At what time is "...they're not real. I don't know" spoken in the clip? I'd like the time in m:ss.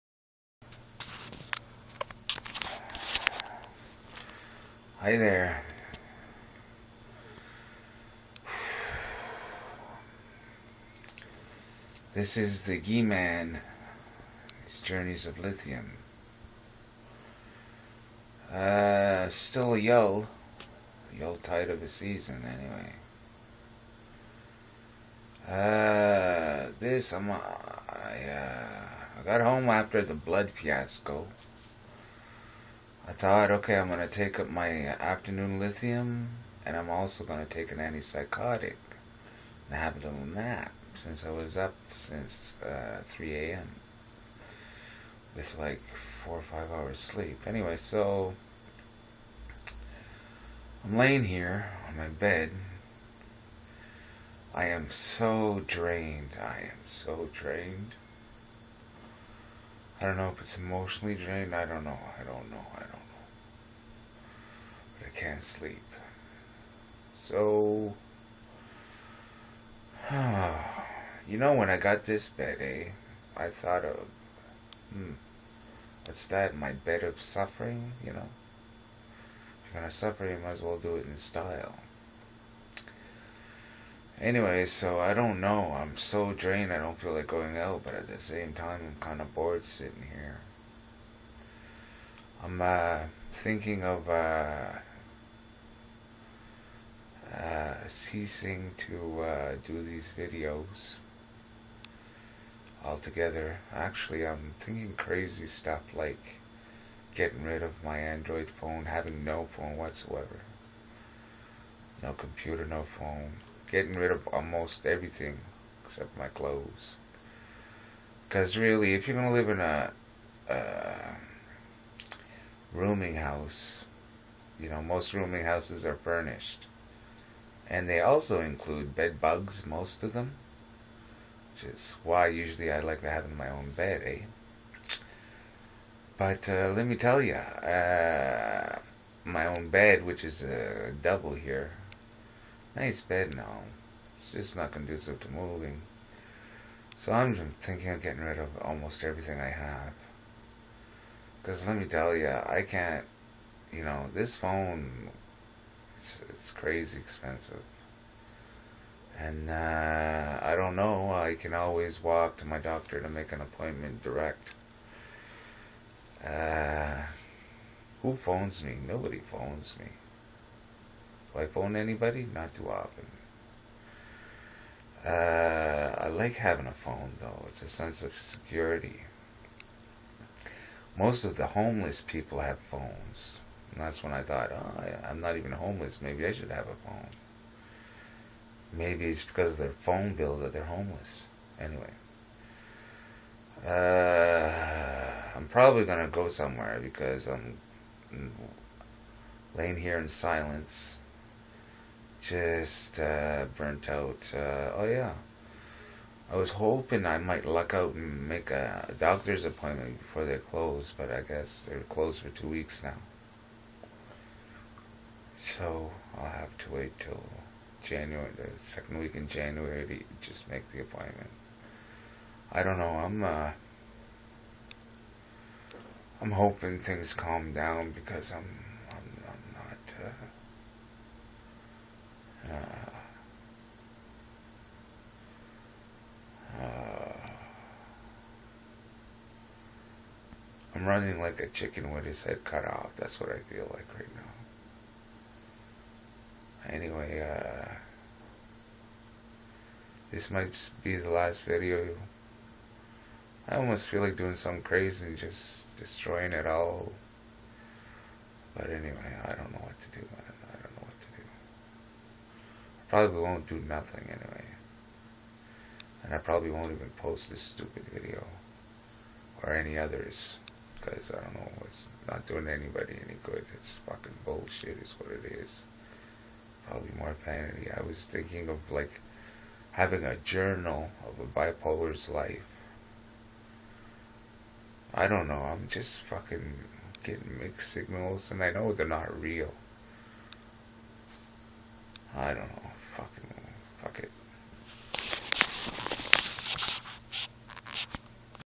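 4:48.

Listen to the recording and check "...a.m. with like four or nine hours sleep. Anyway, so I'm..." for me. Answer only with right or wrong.
wrong.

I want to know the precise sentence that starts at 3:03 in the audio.
And that's when I thought, oh, I, am not even homeless.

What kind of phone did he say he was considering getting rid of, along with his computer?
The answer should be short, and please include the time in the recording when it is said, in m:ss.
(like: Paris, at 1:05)
Android, at 1:47.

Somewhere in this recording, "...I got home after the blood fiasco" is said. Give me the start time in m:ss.
0:29.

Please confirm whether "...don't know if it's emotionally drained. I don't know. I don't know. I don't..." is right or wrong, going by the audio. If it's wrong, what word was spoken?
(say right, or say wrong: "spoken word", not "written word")
right.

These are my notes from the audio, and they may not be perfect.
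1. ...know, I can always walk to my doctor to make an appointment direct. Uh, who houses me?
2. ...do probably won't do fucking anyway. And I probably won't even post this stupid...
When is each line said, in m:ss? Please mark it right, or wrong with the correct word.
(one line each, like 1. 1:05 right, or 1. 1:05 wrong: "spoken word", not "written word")
1. 2:40 wrong: "phones", not "houses"
2. 4:19 wrong: "nothing", not "fucking".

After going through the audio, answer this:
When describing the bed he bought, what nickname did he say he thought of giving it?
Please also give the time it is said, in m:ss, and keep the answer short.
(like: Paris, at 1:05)
Bed of suffering, at 1:16.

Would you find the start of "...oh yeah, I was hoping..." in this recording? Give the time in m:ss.
3:24.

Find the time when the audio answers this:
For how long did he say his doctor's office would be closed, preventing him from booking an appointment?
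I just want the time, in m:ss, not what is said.
3:32.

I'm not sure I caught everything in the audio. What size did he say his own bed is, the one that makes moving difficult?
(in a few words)
Double.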